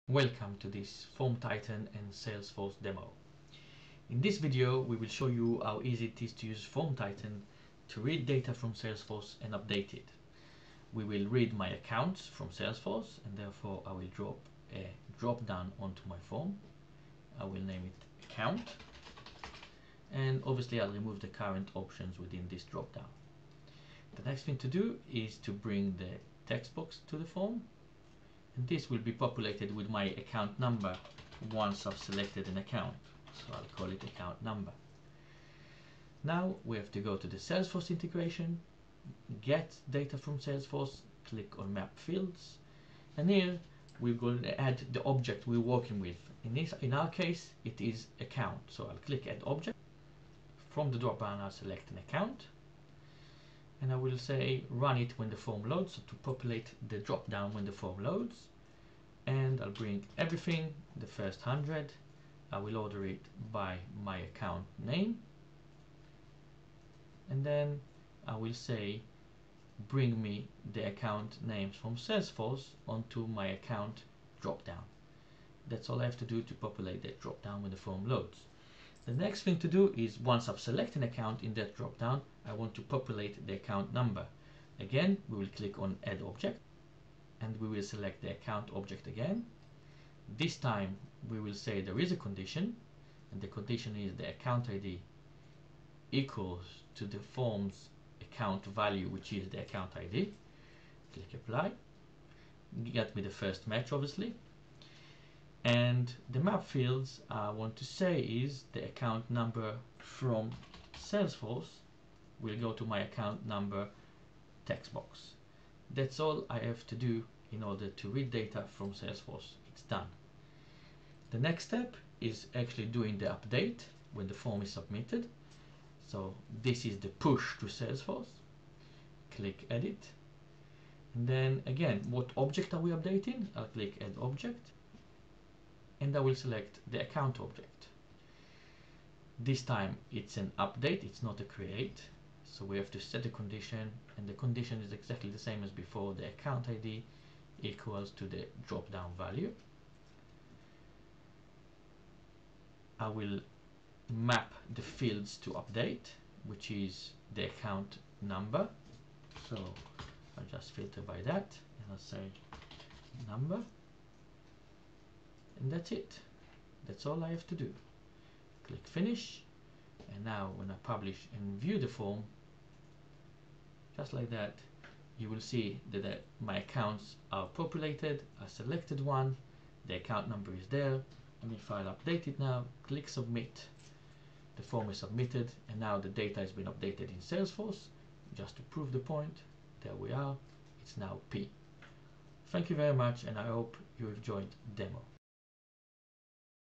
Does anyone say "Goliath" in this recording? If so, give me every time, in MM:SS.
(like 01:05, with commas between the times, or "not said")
not said.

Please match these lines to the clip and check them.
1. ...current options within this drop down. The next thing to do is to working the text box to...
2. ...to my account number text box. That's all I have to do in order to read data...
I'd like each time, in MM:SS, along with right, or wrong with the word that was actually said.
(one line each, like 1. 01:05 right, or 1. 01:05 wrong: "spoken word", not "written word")
1. 00:21 wrong: "bring", not "working"
2. 01:52 right.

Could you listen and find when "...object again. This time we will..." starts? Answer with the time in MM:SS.
01:28.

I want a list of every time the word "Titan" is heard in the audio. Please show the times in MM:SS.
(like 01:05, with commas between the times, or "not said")
00:01, 00:06.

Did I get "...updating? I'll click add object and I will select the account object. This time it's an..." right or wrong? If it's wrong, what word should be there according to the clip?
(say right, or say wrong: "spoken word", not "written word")
right.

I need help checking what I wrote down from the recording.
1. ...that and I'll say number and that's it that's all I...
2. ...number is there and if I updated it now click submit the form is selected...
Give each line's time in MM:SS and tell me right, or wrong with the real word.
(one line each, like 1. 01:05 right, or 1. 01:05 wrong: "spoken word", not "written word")
1. 02:41 right
2. 03:00 wrong: "submitted", not "selected".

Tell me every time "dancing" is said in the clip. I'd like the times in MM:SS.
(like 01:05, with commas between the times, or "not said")
not said.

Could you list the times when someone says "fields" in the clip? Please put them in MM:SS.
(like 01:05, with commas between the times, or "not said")
00:41, 01:46, 02:34.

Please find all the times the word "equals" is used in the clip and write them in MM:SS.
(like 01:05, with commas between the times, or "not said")
01:36, 02:27.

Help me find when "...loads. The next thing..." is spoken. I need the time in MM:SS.
01:18.